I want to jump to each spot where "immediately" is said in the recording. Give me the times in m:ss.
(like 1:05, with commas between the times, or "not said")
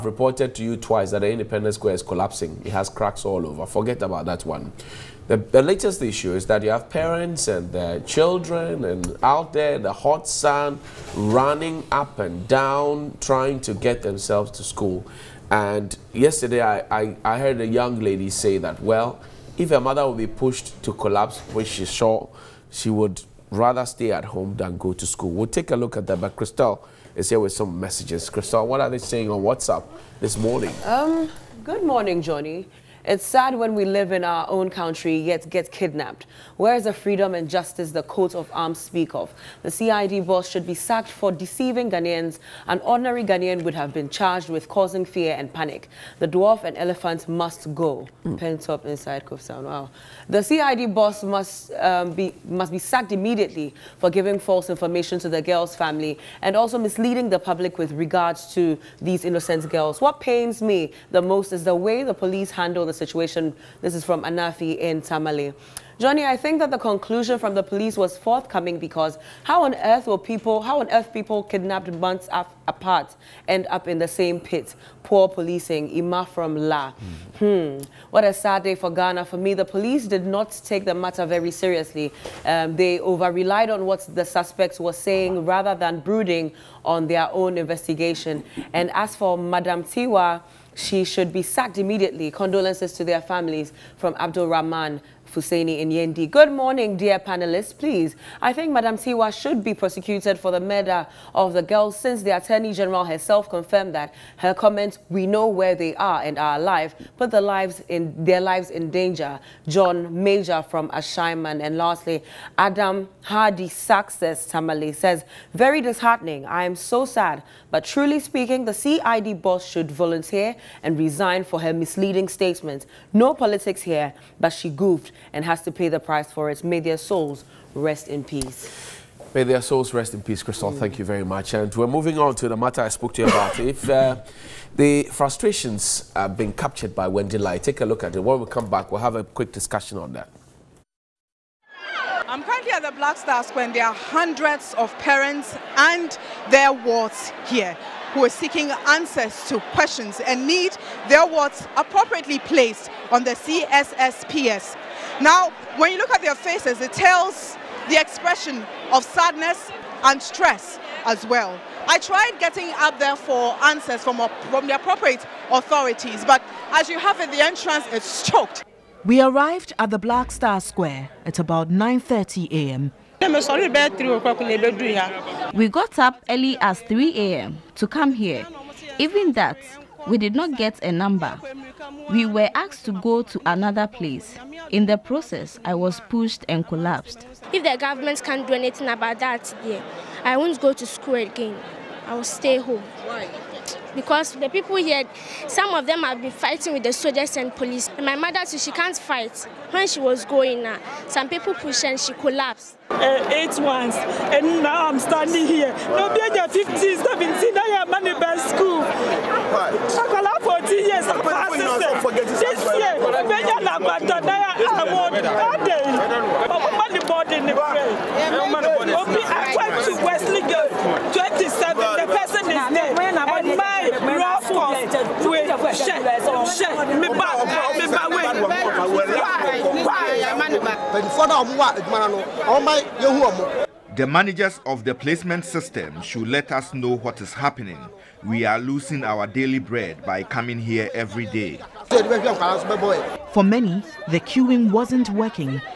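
0:53, 1:31.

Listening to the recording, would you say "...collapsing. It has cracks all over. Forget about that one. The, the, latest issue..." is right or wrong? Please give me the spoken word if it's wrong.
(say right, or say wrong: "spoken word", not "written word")
right.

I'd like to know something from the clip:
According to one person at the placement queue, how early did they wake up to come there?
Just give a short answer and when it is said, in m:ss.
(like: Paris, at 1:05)
3 a.m., at 2:56.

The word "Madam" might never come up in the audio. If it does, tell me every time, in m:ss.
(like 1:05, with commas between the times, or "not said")
1:29, 1:38.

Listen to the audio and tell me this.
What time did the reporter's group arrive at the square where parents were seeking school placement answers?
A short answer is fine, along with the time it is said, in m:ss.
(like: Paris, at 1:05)
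9:30 a.m., at 2:51.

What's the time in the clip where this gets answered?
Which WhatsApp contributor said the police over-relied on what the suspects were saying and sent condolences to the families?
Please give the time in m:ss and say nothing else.
1:34.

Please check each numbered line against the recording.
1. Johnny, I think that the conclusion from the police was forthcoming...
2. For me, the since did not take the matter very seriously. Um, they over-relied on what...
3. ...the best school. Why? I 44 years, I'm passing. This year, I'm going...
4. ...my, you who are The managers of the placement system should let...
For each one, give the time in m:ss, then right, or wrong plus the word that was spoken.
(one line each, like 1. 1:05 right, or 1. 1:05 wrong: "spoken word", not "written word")
1. 1:05 right
2. 1:19 wrong: "police", not "since"
3. 3:28 wrong: "14", not "44"
4. 3:52 right.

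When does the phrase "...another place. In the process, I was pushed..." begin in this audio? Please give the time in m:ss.
3:03.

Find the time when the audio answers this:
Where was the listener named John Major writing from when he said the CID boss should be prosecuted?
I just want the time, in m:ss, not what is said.
1:50.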